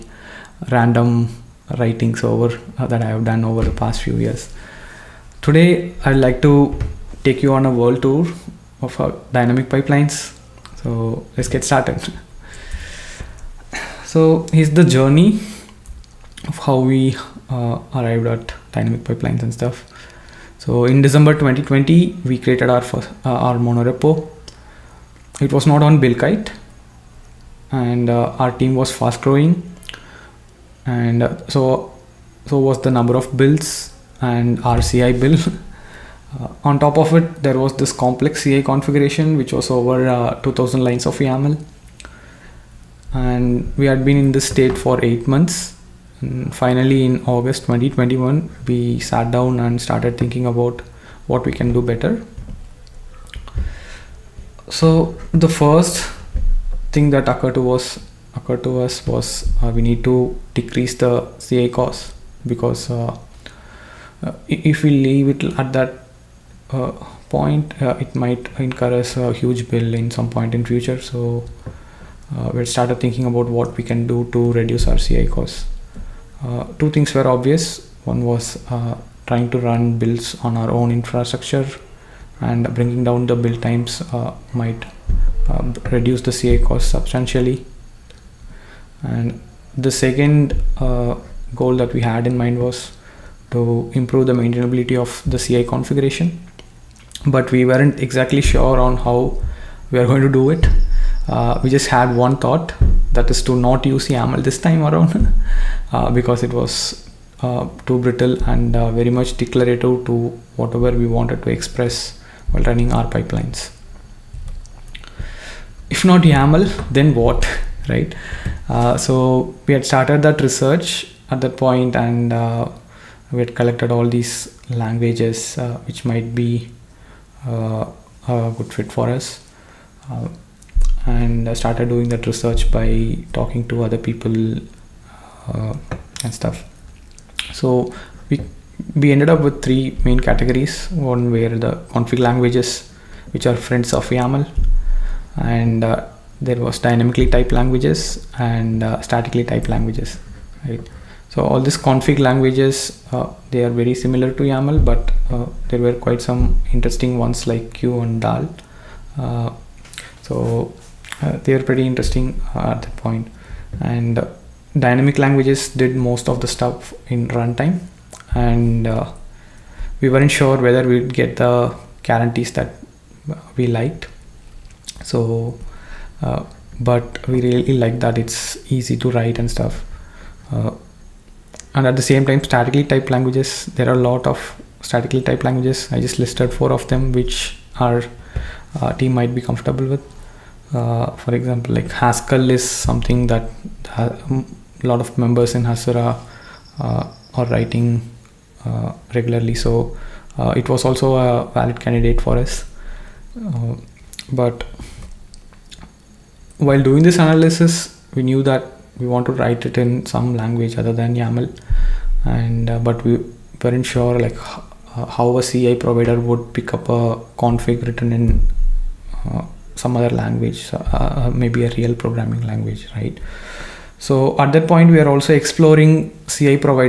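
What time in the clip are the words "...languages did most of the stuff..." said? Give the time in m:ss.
2:45.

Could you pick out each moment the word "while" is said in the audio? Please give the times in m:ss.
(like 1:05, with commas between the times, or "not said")
1:52, 3:26.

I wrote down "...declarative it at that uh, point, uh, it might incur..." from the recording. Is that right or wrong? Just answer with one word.
wrong.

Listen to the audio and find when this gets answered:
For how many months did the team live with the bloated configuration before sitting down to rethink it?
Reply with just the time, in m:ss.
0:45.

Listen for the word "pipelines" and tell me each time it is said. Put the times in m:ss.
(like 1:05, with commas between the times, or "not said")
0:09, 0:19, 1:53.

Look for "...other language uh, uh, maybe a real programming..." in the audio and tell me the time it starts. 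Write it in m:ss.
3:39.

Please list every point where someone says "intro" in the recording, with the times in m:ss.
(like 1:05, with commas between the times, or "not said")
not said.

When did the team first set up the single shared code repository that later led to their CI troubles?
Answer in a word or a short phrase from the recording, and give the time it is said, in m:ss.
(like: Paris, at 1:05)
December 2020, at 0:21.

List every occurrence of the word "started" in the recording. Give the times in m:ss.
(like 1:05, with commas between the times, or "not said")
0:11, 0:49, 1:12, 1:59, 2:11.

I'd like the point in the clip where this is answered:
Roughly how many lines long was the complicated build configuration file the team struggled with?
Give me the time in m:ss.
0:39.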